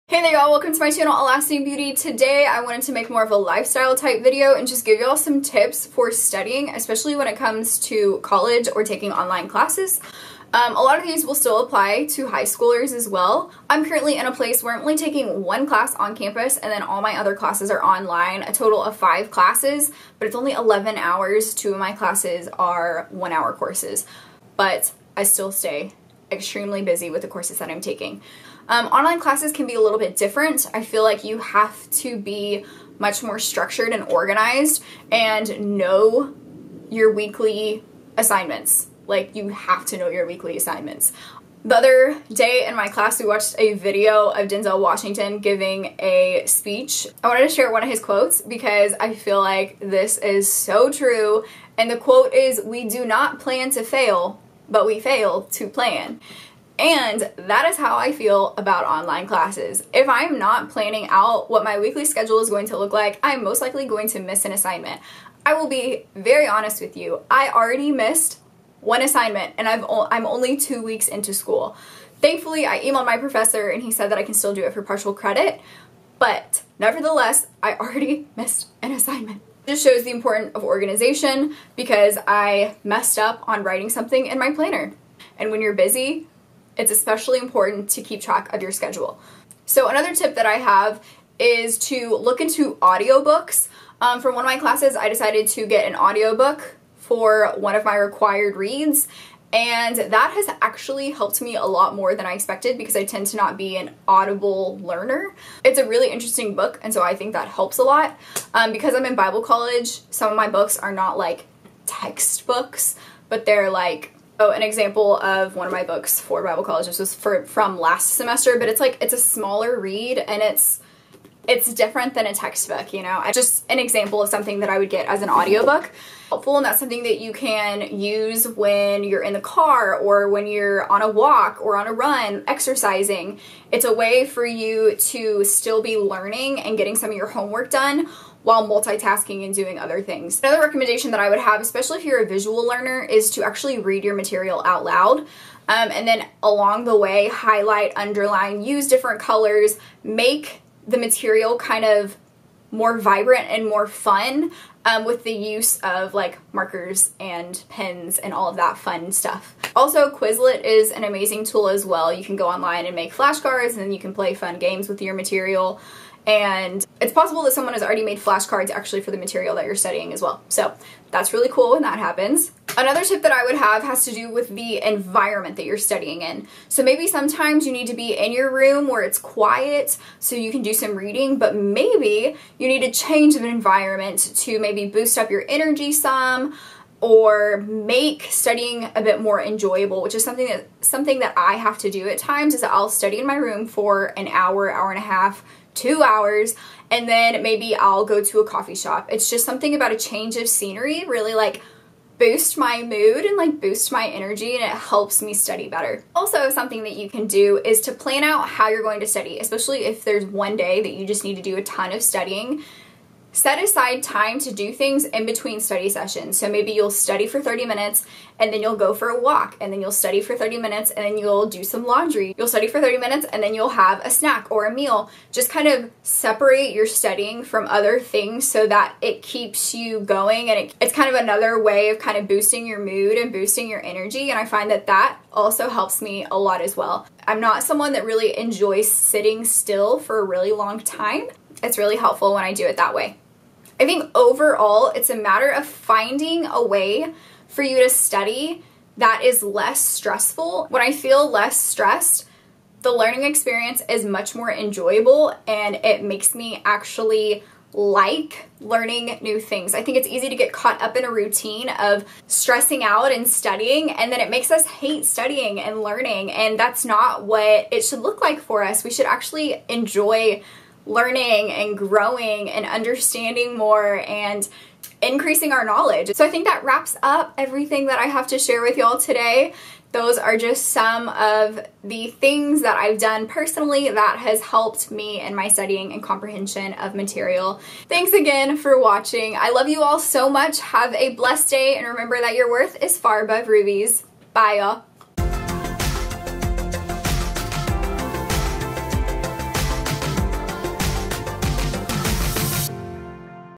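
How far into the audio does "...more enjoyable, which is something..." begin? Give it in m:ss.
3:09.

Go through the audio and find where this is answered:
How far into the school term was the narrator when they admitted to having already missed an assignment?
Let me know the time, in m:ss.
1:10.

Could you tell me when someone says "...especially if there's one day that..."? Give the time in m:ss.
3:29.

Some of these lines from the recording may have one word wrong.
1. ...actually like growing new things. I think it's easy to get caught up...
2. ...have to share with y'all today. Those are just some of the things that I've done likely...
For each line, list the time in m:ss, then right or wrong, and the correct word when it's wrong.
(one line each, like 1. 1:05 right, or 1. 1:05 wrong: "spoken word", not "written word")
1. 4:16 wrong: "learning", not "growing"
2. 4:38 wrong: "personally", not "likely".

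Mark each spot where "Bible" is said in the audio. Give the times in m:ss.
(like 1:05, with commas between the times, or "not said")
1:49, 1:56.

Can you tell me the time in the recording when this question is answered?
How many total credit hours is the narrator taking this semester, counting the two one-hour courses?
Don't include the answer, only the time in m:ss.
0:20.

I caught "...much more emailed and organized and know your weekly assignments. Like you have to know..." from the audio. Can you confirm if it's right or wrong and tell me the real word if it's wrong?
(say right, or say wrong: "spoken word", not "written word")
wrong: "structured", not "emailed".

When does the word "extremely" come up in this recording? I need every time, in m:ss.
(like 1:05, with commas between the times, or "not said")
0:26.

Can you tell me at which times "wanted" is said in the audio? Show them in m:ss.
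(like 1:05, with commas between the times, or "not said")
0:02, 0:47.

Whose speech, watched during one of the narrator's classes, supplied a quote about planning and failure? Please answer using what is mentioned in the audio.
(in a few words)
Denzel Washington.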